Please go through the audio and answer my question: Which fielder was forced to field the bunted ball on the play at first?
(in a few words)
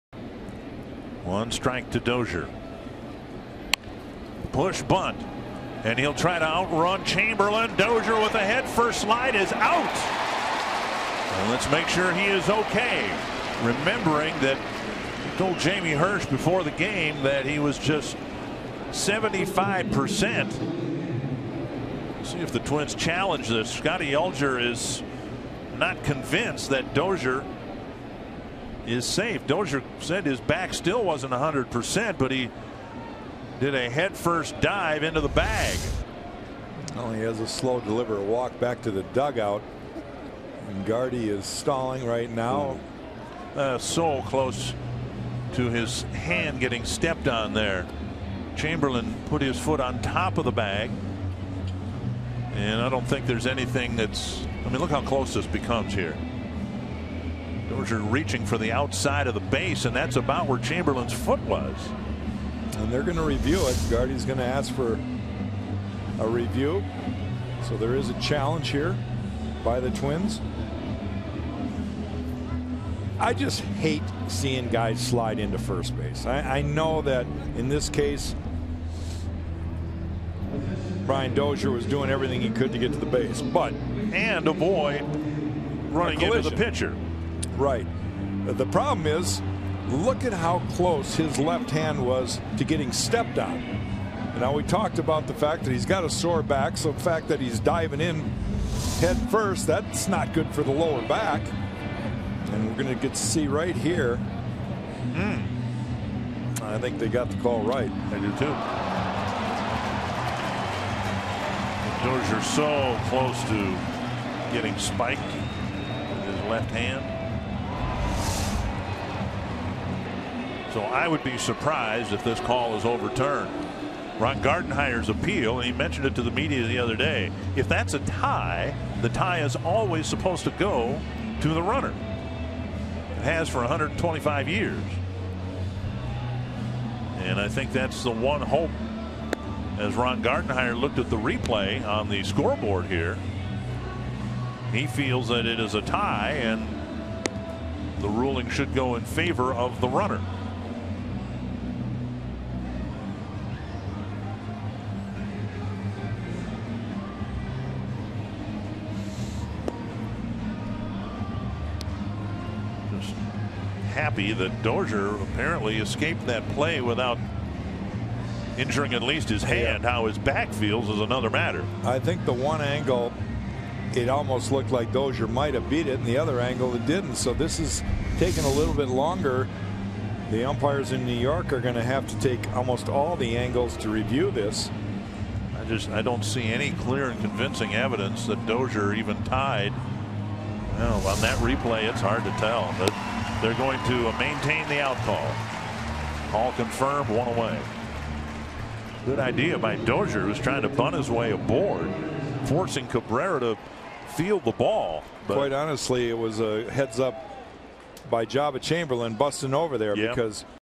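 Cabrera.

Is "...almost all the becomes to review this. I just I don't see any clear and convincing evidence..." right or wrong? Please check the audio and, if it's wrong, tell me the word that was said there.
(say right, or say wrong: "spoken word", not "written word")
wrong: "angles", not "becomes".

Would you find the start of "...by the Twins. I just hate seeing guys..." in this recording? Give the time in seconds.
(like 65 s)
69 s.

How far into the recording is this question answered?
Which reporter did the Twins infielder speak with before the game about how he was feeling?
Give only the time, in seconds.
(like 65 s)
15 s.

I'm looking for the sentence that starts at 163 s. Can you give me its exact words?
was happy that Dozier apparently escaped that play without injuring at least his hand.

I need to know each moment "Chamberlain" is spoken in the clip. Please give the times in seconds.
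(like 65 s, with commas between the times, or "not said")
7 s, 48 s, 60 s, 208 s.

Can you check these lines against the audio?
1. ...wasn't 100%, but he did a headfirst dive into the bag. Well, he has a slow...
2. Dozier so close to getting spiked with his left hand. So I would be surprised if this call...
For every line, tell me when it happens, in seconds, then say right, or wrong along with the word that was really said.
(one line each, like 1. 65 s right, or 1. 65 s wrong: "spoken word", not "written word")
1. 31 s right
2. 112 s right.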